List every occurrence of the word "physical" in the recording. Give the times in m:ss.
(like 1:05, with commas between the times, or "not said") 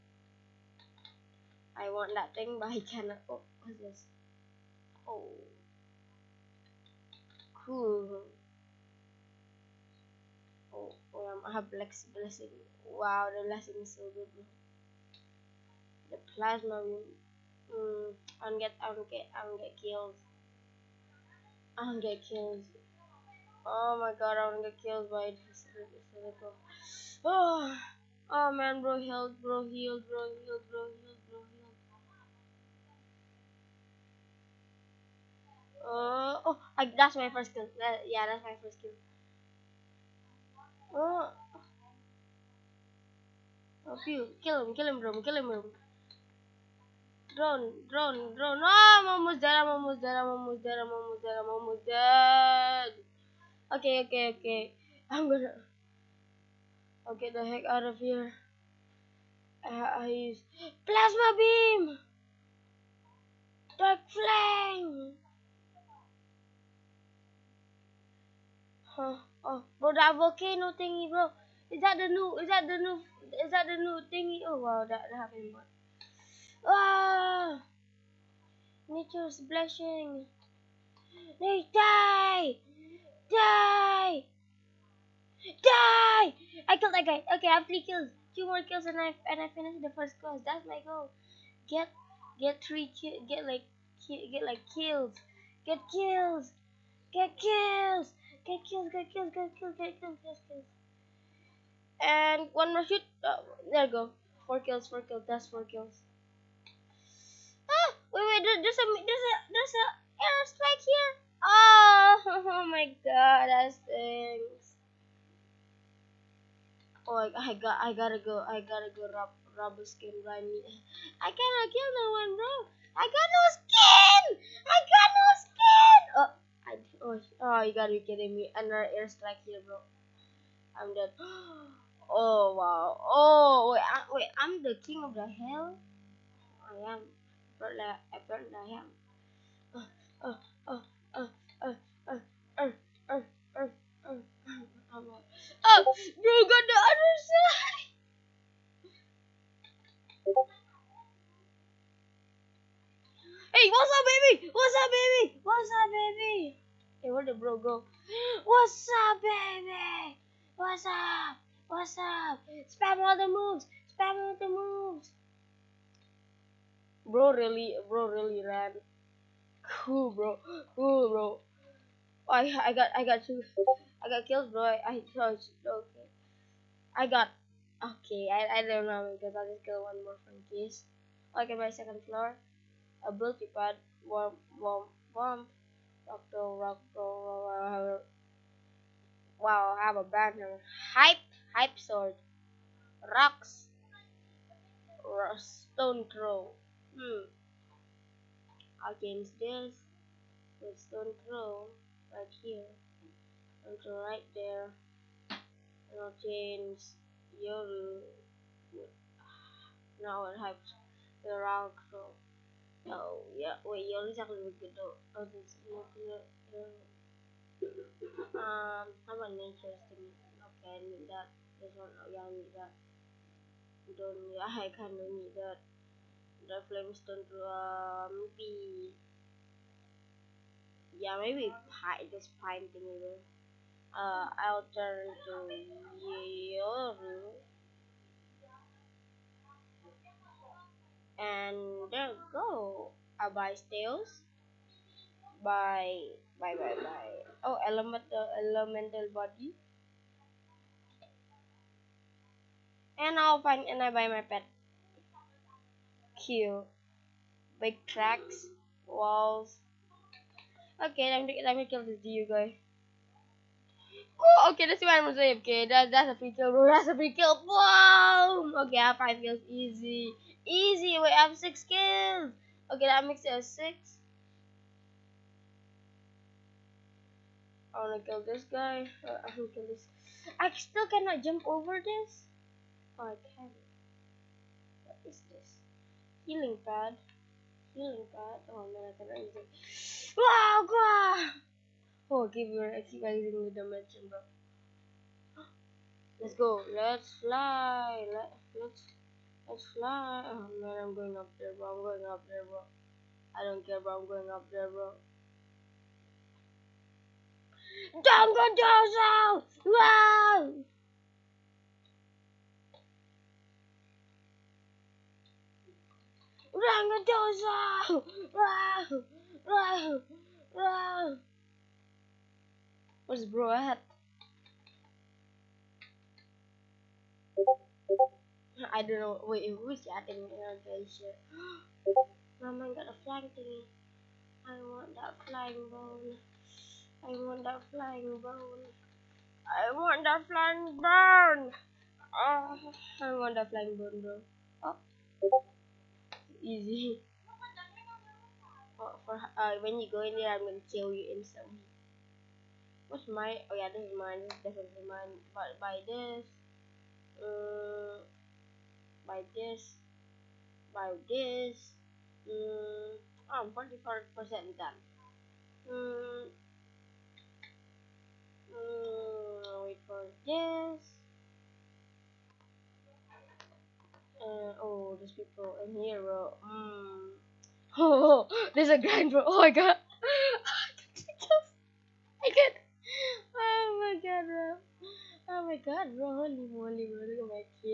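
0:25.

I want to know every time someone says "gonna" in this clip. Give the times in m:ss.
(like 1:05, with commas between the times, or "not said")
0:55, 5:50.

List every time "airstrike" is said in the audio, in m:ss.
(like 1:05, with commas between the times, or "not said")
1:50, 2:08.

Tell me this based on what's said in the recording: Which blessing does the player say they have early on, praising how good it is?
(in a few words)
Black's Blessing.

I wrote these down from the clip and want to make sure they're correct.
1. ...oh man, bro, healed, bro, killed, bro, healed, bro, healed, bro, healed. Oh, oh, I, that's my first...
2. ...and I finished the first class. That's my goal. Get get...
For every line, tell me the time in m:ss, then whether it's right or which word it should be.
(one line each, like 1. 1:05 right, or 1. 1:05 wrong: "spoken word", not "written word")
1. 0:28 wrong: "healed", not "killed"
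2. 1:29 right.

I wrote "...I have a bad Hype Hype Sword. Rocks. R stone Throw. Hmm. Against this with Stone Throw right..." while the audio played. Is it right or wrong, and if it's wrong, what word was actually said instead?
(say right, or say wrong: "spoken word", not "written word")
right.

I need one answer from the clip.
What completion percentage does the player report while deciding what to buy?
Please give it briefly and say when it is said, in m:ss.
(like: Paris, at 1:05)
44%, at 6:03.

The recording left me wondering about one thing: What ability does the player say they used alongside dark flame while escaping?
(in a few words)
plasma beam.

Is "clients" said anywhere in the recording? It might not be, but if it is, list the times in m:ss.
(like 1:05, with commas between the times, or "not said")
not said.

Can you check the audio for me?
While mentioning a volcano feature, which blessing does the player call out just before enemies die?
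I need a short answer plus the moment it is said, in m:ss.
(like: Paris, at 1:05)
nature's blessing, at 1:18.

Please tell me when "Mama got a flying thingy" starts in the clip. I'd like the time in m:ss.
5:32.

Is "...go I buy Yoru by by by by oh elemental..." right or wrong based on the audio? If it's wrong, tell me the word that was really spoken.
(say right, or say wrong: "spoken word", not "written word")
wrong: "Tails", not "Yoru".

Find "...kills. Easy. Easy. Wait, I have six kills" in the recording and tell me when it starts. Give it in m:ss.
4:29.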